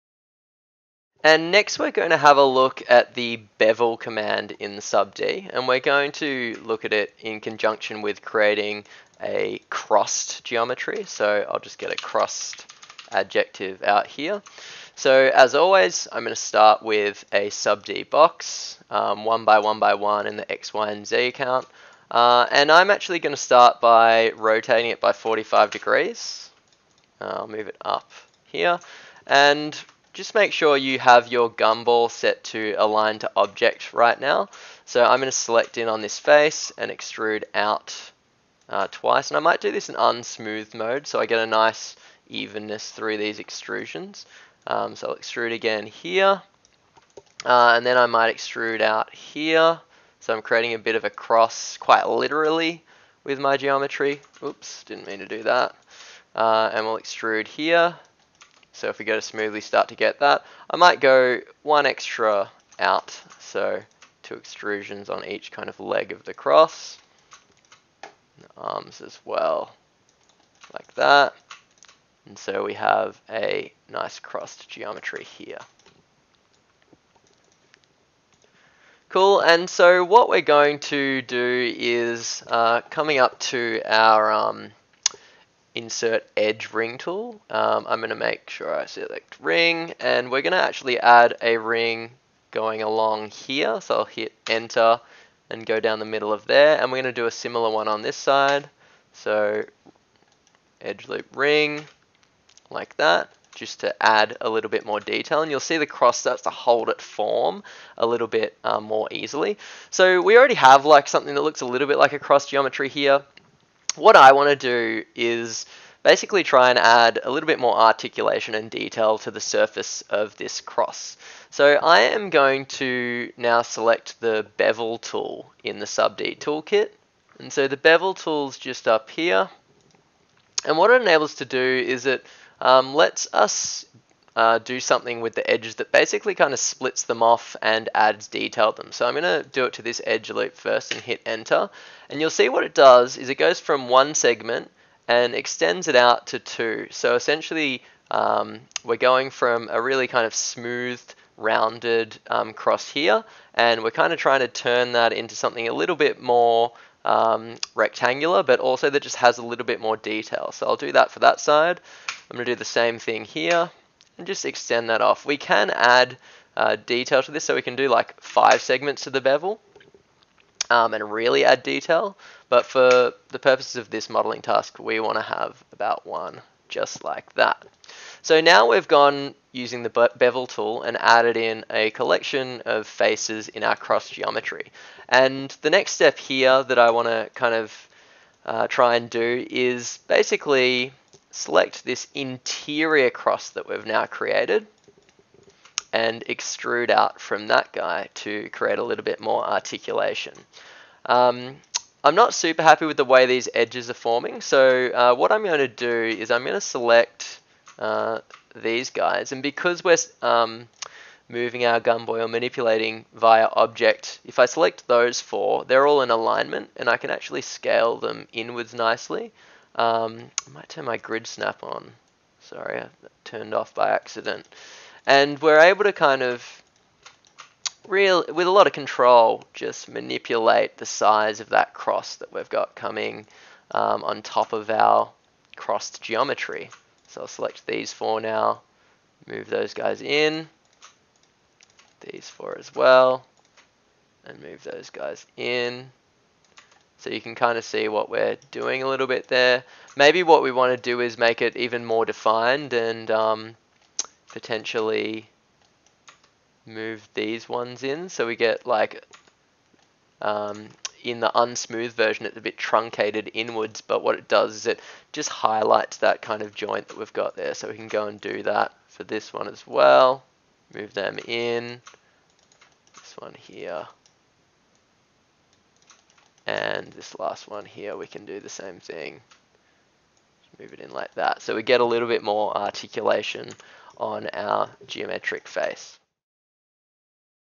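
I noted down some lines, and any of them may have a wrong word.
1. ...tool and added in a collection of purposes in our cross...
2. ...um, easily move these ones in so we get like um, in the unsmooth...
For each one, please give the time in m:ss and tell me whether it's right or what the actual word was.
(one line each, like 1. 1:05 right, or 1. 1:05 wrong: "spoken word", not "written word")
1. 3:00 wrong: "faces", not "purposes"
2. 4:13 wrong: "potentially", not "easily".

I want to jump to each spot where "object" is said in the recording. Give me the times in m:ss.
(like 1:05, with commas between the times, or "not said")
0:33, 3:33.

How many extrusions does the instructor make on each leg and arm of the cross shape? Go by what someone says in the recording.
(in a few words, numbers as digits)
2.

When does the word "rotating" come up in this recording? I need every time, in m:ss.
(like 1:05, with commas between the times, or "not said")
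0:24.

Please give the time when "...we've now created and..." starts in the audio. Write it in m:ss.
3:13.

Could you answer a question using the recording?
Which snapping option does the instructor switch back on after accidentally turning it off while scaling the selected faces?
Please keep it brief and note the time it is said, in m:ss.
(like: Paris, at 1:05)
grid snap, at 3:40.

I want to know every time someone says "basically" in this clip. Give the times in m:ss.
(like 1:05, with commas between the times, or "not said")
1:56, 2:15, 3:10.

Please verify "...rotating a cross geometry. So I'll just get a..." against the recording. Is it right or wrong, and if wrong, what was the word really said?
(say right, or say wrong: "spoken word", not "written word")
wrong: "creating", not "rotating".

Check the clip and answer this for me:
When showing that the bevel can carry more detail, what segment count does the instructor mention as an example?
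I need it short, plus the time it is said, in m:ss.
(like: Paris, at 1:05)
5, at 2:48.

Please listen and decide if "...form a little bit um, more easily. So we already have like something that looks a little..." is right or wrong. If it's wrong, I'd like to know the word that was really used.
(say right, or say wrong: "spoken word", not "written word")
right.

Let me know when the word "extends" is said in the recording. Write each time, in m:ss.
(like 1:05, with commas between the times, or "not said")
2:25, 2:44.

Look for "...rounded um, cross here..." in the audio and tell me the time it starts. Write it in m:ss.
2:31.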